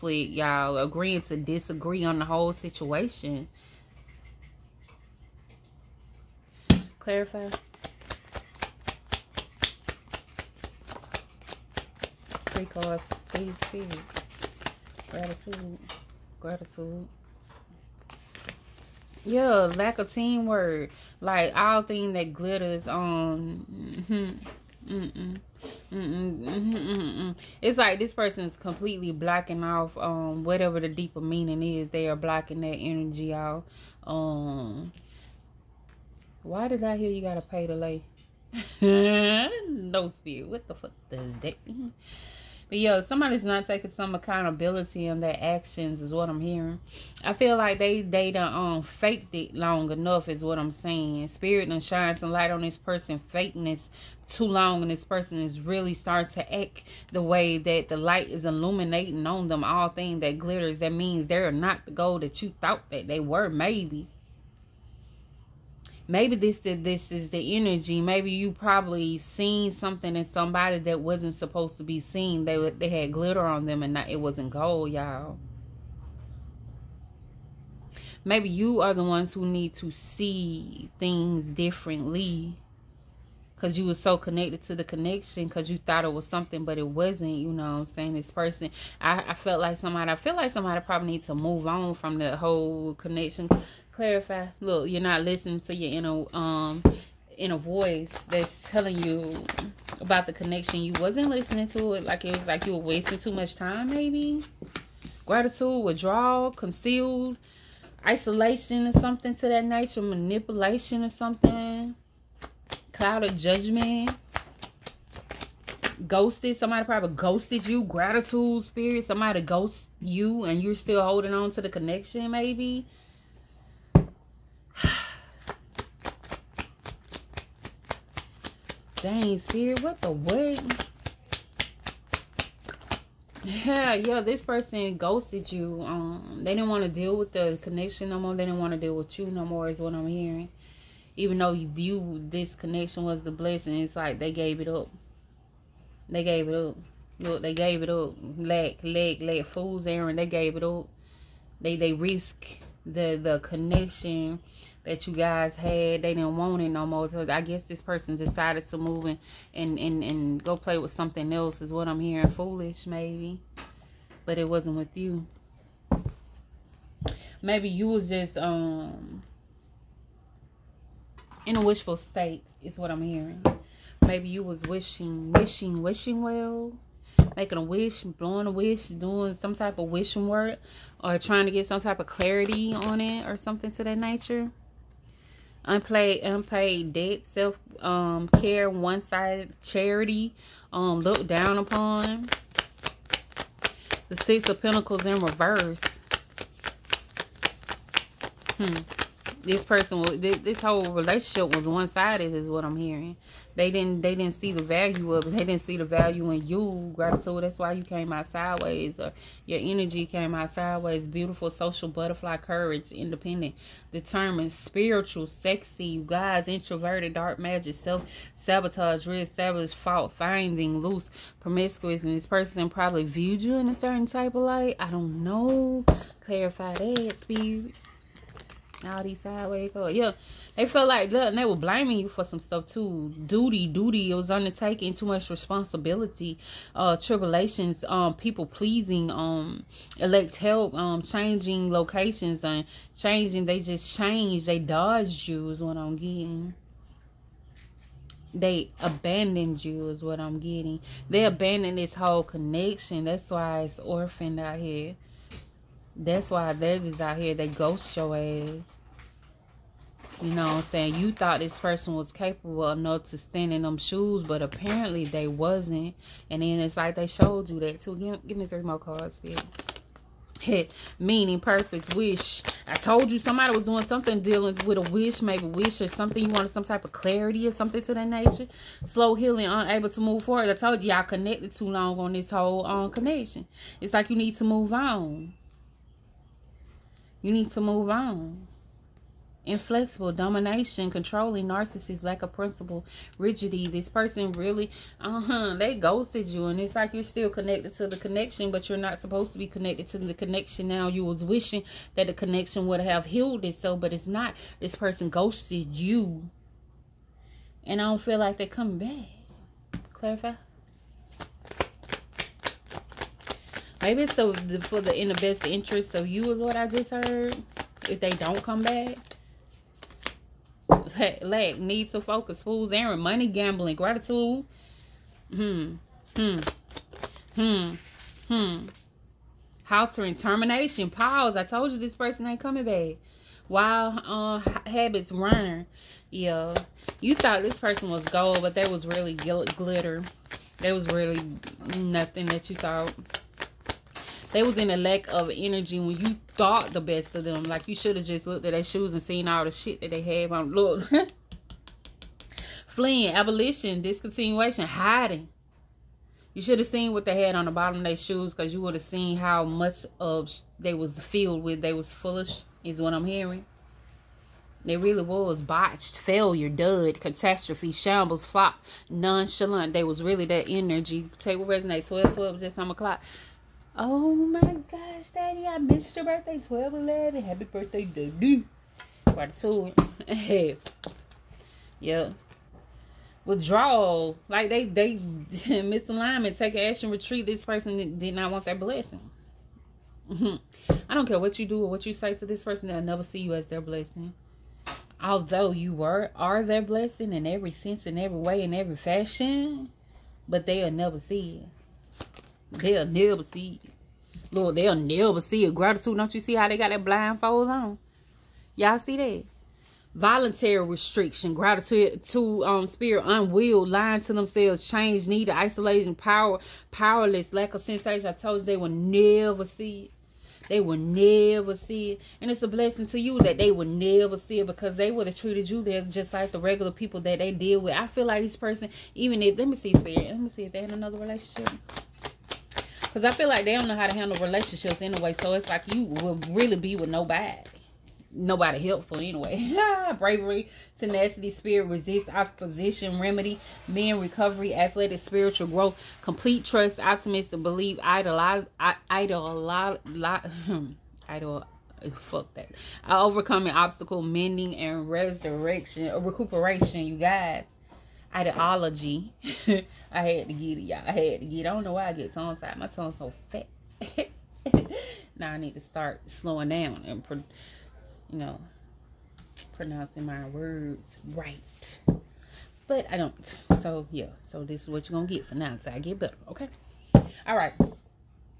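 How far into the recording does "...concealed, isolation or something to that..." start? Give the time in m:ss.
1:46.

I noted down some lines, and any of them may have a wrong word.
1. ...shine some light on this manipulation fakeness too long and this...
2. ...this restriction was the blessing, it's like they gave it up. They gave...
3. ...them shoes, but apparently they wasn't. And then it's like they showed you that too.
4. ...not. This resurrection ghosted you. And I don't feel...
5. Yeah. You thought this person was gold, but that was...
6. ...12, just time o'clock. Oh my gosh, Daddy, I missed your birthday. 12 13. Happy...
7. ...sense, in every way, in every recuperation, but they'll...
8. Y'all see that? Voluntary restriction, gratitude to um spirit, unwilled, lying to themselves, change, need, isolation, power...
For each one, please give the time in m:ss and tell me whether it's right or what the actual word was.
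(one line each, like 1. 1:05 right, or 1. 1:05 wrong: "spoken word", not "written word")
1. 0:51 wrong: "person", not "manipulation"
2. 2:22 wrong: "connection", not "restriction"
3. 4:23 right
4. 5:04 wrong: "person", not "resurrection"
5. 5:36 right
6. 6:12 wrong: "11", not "13"
7. 6:37 wrong: "fashion", not "recuperation"
8. 6:48 right.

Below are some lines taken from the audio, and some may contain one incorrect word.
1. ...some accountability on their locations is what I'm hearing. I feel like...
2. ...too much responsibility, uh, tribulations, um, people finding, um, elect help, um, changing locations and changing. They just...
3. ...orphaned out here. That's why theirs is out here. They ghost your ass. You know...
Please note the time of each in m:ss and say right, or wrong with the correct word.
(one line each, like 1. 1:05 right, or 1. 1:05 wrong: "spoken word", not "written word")
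1. 0:43 wrong: "actions", not "locations"
2. 3:54 wrong: "pleasing", not "finding"
3. 4:13 right.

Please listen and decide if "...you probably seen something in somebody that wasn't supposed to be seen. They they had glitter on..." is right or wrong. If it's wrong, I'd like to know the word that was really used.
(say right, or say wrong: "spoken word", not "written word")
right.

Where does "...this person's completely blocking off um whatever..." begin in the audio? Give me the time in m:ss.
0:27.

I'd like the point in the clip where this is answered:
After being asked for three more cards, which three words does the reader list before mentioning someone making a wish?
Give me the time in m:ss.
4:30.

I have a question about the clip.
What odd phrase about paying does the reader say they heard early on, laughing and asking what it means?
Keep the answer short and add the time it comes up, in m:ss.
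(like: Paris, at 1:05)
gotta pay to lay, at 0:37.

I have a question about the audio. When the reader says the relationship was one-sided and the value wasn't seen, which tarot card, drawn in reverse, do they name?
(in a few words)
Six of Pentacles.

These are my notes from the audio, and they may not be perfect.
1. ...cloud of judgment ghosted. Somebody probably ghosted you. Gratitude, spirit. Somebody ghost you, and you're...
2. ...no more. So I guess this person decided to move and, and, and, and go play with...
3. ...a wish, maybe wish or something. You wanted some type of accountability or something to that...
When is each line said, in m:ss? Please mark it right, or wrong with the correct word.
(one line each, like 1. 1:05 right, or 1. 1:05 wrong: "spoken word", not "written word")
1. 1:52 right
2. 2:36 right
3. 4:34 wrong: "clarity", not "accountability".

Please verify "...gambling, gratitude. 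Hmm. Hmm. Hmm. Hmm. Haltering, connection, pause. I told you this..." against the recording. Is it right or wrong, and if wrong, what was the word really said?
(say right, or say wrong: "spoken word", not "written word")
wrong: "termination", not "connection".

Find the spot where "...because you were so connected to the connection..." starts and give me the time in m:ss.
1:23.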